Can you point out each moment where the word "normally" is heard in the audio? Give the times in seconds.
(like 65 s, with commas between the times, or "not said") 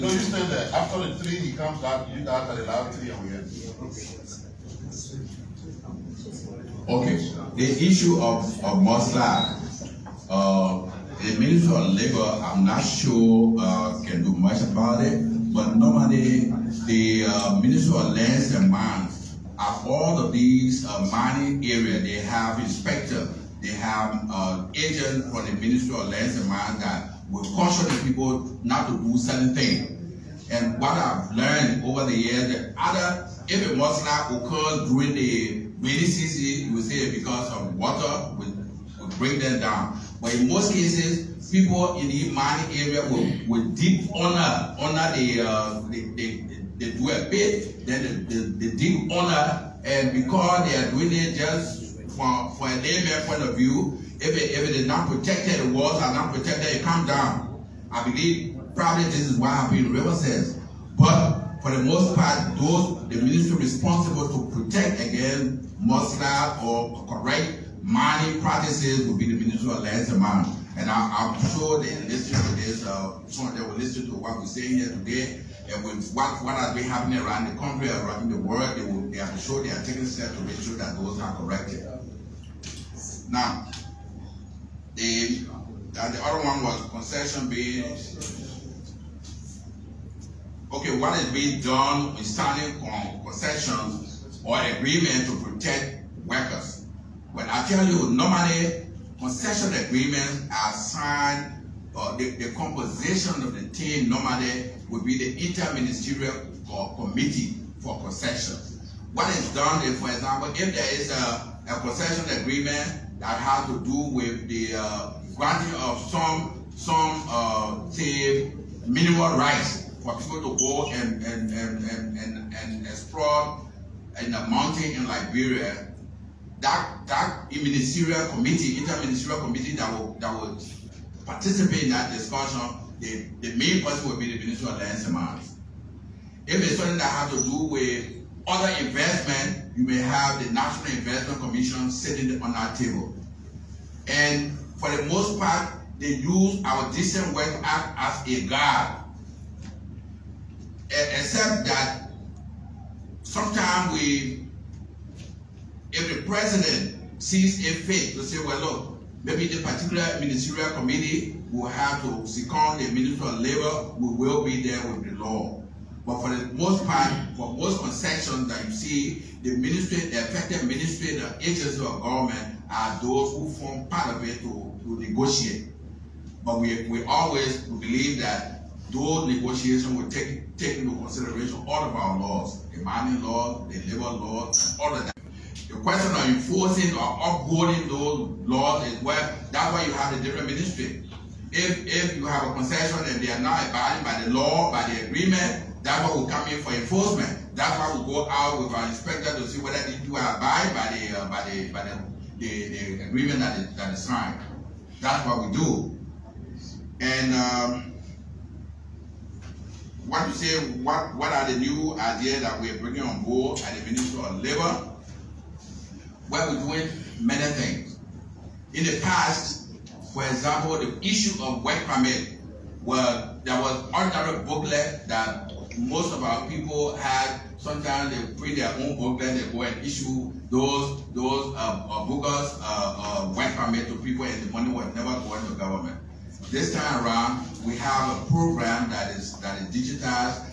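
15 s, 98 s, 104 s.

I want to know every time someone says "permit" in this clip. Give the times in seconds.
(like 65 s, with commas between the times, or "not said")
221 s, 233 s.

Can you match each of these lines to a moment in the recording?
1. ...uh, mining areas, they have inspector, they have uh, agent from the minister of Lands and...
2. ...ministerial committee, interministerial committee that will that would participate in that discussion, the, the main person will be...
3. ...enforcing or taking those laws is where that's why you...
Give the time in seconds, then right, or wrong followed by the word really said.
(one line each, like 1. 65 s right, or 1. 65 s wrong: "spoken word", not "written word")
1. 20 s right
2. 127 s right
3. 186 s wrong: "upholding", not "taking".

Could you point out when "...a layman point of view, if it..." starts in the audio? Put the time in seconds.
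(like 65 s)
52 s.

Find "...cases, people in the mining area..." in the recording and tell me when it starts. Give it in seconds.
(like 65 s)
40 s.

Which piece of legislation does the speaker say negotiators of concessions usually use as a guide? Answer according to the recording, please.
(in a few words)
Decent Work Act.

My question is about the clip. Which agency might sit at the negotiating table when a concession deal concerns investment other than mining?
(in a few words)
National Investment Commission.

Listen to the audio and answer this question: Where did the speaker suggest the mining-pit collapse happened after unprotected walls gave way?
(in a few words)
Riverside.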